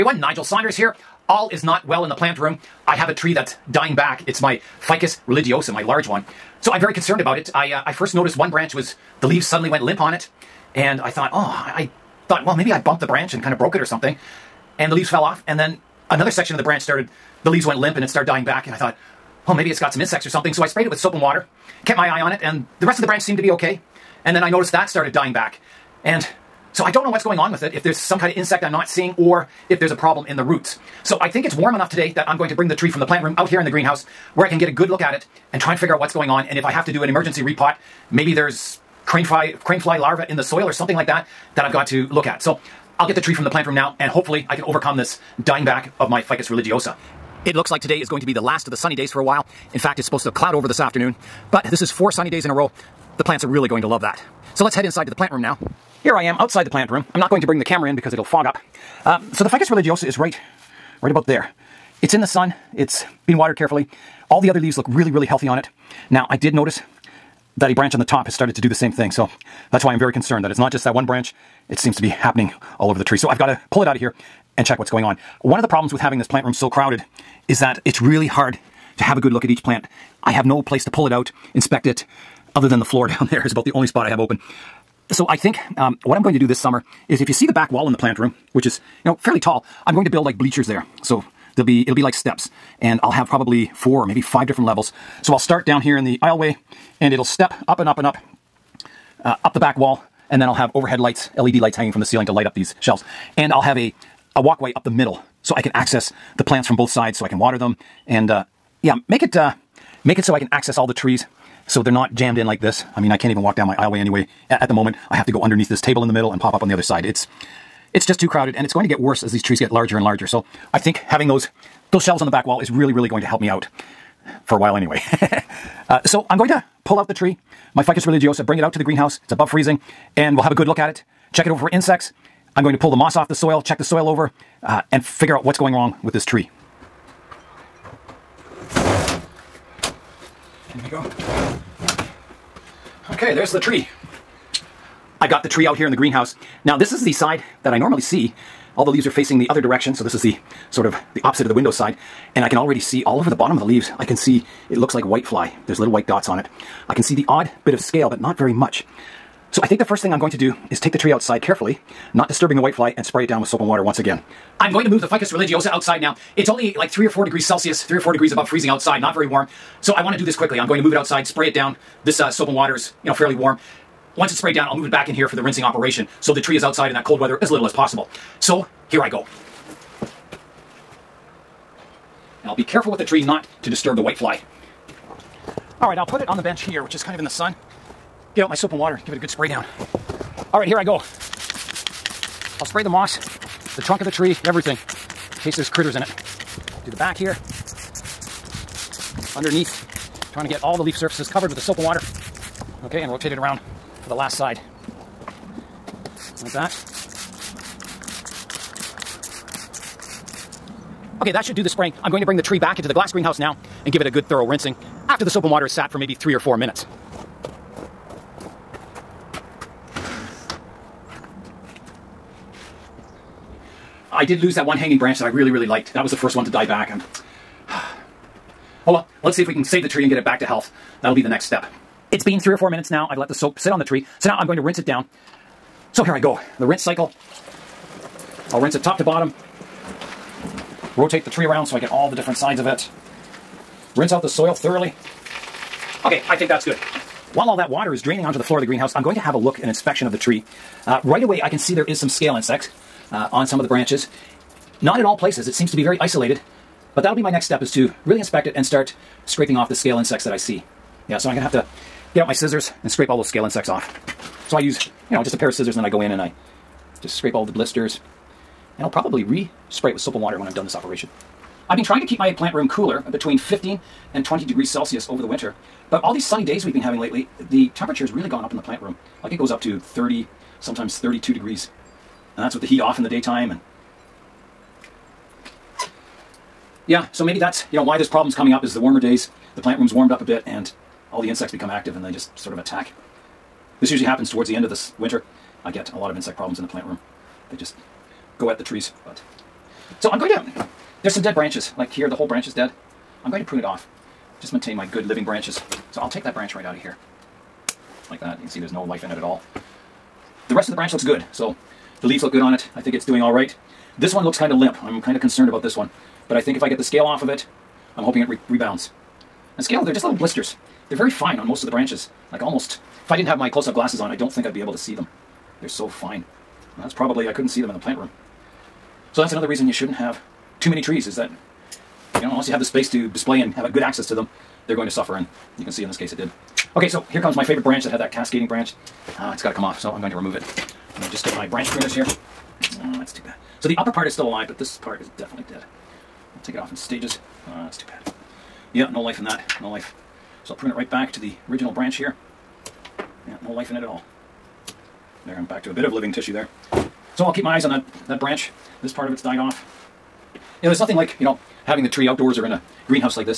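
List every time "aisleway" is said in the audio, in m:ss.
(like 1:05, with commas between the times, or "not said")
1:36, 1:53.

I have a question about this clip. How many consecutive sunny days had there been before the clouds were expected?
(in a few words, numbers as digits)
4.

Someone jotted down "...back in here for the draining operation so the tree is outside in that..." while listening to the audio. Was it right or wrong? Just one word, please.
wrong.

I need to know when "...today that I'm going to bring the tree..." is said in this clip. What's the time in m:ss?
0:31.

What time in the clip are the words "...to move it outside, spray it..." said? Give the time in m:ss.
2:50.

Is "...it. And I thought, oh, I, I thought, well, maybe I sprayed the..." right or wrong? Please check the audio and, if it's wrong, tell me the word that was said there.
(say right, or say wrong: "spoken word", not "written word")
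wrong: "bumped", not "sprayed".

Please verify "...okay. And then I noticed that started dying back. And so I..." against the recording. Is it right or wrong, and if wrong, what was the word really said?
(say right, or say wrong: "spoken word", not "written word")
right.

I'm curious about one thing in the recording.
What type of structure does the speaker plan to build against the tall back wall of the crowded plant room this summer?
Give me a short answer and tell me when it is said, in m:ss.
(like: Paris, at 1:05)
Bleachers, at 1:30.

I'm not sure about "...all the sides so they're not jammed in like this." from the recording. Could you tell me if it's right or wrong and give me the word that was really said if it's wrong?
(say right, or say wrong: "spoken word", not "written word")
wrong: "trees", not "sides".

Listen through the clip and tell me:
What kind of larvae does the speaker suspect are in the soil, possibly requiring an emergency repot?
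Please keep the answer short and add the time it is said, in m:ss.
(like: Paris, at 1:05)
Crane fly larvae, at 0:39.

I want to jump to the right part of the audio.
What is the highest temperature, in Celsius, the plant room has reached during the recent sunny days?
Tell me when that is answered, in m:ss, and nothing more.
4:40.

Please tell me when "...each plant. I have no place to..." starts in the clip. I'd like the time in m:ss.
1:19.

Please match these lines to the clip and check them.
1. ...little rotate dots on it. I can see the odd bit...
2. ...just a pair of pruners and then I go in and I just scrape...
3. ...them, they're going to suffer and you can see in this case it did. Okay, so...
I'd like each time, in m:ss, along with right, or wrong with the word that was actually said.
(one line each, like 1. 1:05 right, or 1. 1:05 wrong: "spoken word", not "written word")
1. 2:35 wrong: "white", not "rotate"
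2. 4:25 wrong: "scissors", not "pruners"
3. 5:34 right.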